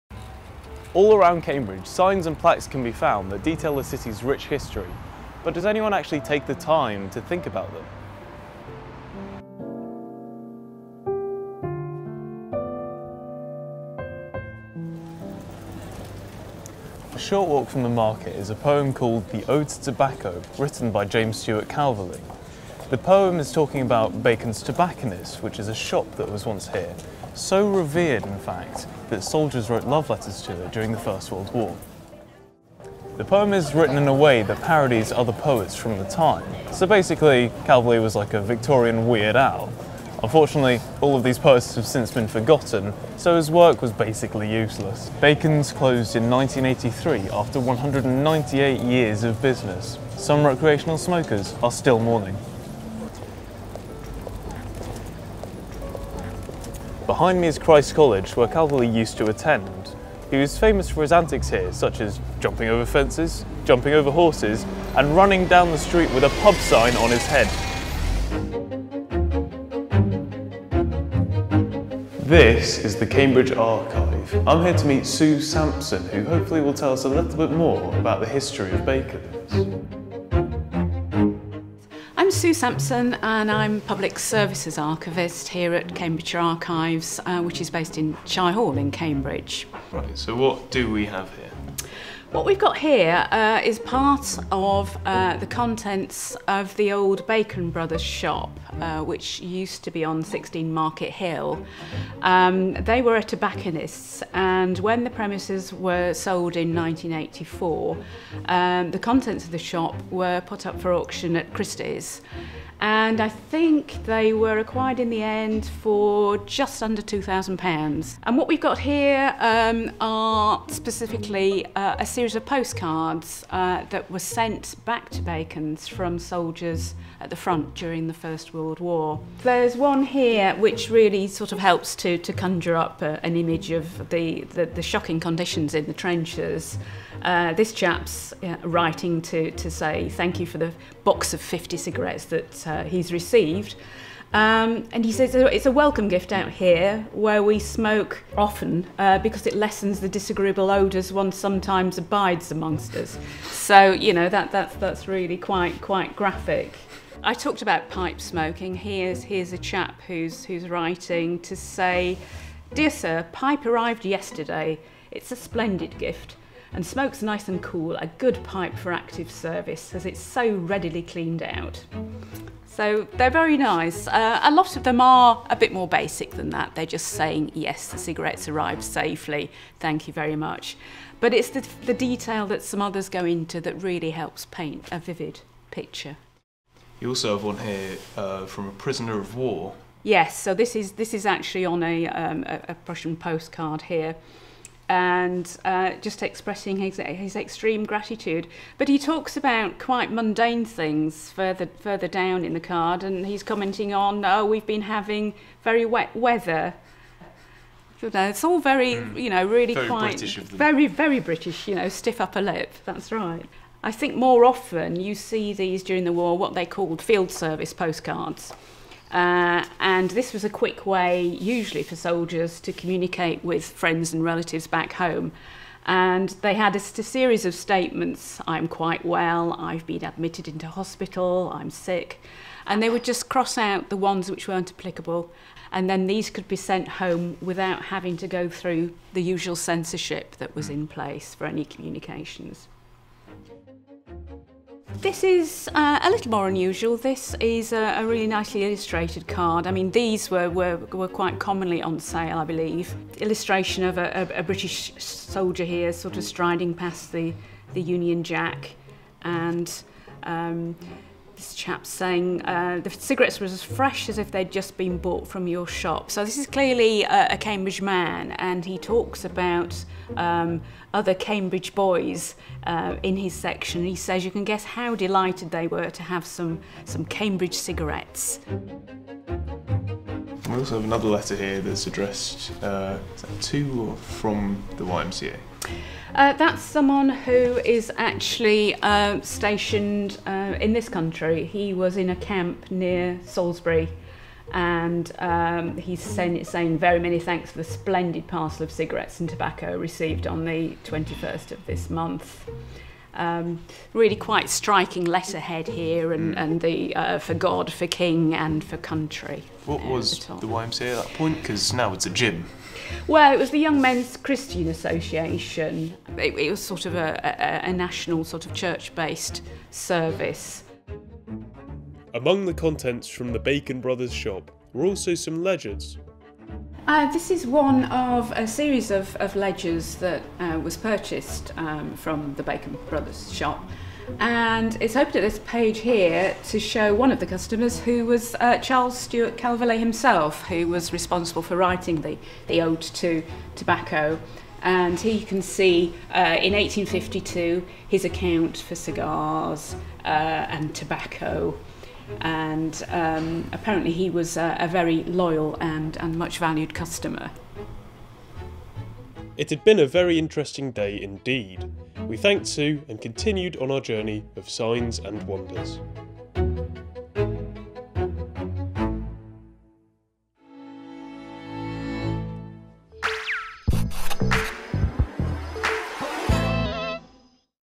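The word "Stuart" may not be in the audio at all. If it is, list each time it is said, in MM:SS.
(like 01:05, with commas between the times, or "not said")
00:21, 05:38.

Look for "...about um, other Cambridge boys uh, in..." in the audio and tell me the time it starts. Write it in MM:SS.
04:29.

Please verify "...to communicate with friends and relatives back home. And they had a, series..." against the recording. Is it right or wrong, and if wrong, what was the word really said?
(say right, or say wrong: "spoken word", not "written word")
right.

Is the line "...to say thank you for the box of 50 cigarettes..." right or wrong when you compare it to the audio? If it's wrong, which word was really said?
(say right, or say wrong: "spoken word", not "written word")
right.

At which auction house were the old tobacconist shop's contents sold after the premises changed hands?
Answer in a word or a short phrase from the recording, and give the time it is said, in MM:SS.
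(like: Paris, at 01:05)
Christie's, at 01:51.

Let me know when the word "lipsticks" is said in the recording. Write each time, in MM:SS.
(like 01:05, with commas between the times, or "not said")
not said.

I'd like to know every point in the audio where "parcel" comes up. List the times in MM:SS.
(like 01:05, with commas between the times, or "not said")
04:58.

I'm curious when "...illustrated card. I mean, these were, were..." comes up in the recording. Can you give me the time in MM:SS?
04:08.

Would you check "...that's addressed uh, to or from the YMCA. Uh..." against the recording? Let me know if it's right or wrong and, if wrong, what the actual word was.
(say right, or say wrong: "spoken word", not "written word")
right.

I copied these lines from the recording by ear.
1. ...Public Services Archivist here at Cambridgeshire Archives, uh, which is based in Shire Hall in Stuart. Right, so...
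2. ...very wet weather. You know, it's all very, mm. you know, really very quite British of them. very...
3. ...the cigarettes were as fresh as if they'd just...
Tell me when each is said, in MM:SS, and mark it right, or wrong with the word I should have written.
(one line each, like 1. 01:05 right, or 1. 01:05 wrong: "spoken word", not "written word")
1. 01:23 wrong: "Cambridge", not "Stuart"
2. 03:25 right
3. 04:22 right.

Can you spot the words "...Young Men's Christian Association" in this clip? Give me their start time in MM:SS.
05:13.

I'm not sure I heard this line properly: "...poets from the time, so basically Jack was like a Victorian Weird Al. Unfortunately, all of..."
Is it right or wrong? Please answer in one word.
wrong.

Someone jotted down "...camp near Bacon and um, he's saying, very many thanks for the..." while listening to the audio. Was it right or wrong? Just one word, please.
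wrong.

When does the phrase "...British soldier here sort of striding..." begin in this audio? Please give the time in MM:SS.
04:14.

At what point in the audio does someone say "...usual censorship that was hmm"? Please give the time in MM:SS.
03:59.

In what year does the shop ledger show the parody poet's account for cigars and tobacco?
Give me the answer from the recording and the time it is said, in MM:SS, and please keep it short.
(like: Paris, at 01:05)
1852, at 05:46.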